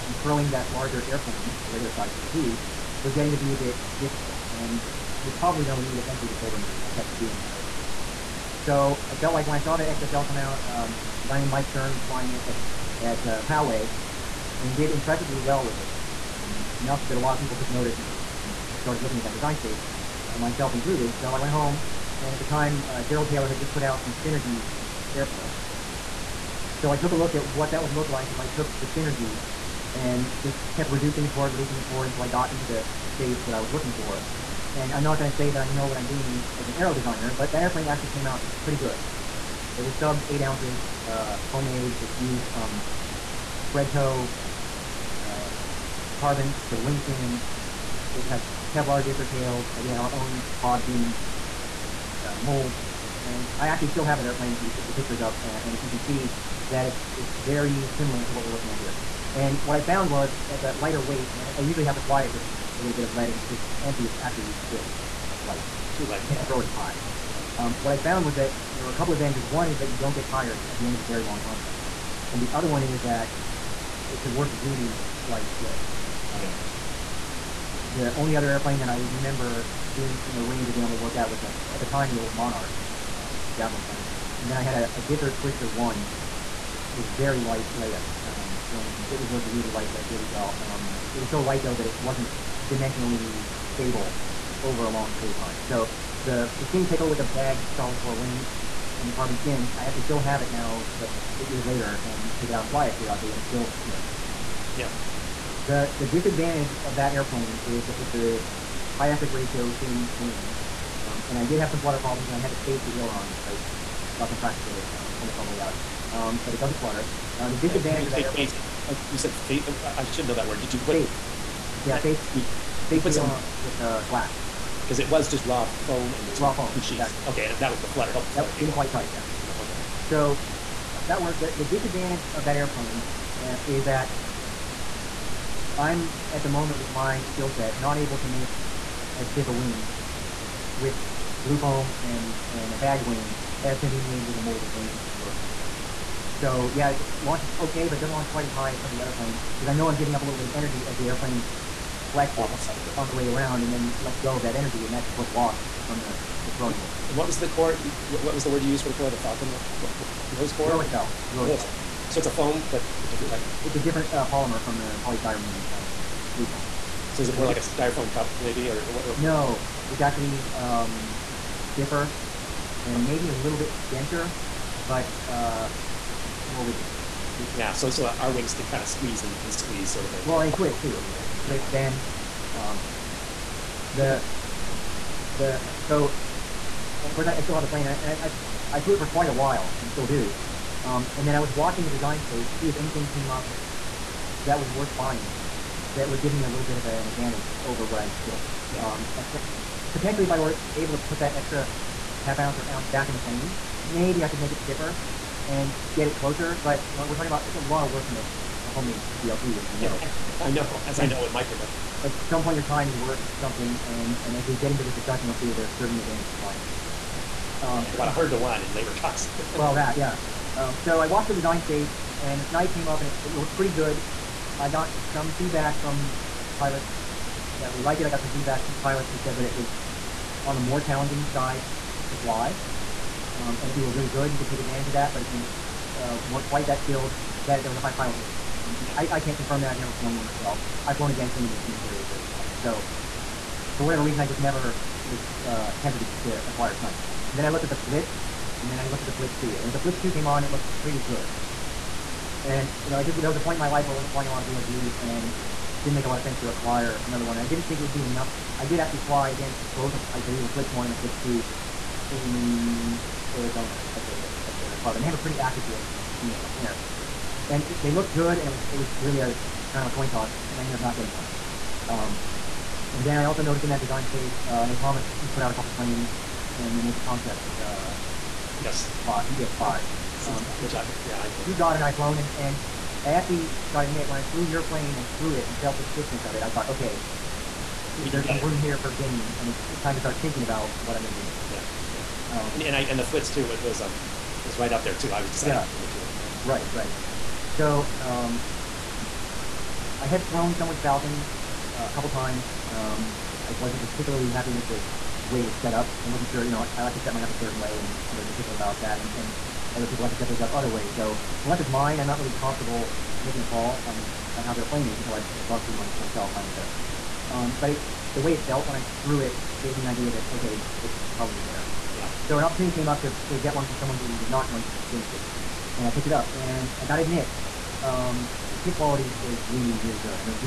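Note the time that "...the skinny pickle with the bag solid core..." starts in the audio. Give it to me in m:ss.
1:36.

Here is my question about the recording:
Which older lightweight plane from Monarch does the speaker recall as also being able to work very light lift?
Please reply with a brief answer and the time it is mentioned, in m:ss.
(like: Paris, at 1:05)
javelin, at 1:23.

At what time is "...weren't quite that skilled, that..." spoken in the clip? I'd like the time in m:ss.
3:56.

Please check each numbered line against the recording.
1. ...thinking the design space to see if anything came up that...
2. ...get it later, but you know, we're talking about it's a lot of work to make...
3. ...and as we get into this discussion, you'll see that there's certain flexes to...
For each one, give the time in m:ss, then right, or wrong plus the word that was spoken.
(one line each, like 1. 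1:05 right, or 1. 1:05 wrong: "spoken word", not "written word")
1. 3:11 wrong: "watching", not "thinking"
2. 3:25 wrong: "closer", not "later"
3. 3:34 wrong: "advantages", not "flexes".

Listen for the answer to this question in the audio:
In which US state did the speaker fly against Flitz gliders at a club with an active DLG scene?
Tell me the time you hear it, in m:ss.
4:23.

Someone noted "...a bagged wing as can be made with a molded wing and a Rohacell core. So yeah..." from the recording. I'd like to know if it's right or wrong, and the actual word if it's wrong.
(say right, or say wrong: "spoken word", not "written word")
right.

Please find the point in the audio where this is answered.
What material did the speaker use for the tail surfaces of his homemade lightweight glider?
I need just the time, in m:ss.
0:48.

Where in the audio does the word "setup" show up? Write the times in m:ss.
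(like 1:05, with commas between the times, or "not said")
5:16.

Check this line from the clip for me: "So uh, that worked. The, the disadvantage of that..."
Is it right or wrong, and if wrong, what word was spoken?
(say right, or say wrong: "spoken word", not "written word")
right.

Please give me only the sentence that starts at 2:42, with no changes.
So it's a foam, but a different type?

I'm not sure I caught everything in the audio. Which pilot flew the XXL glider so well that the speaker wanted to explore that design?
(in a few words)
Mike Stern.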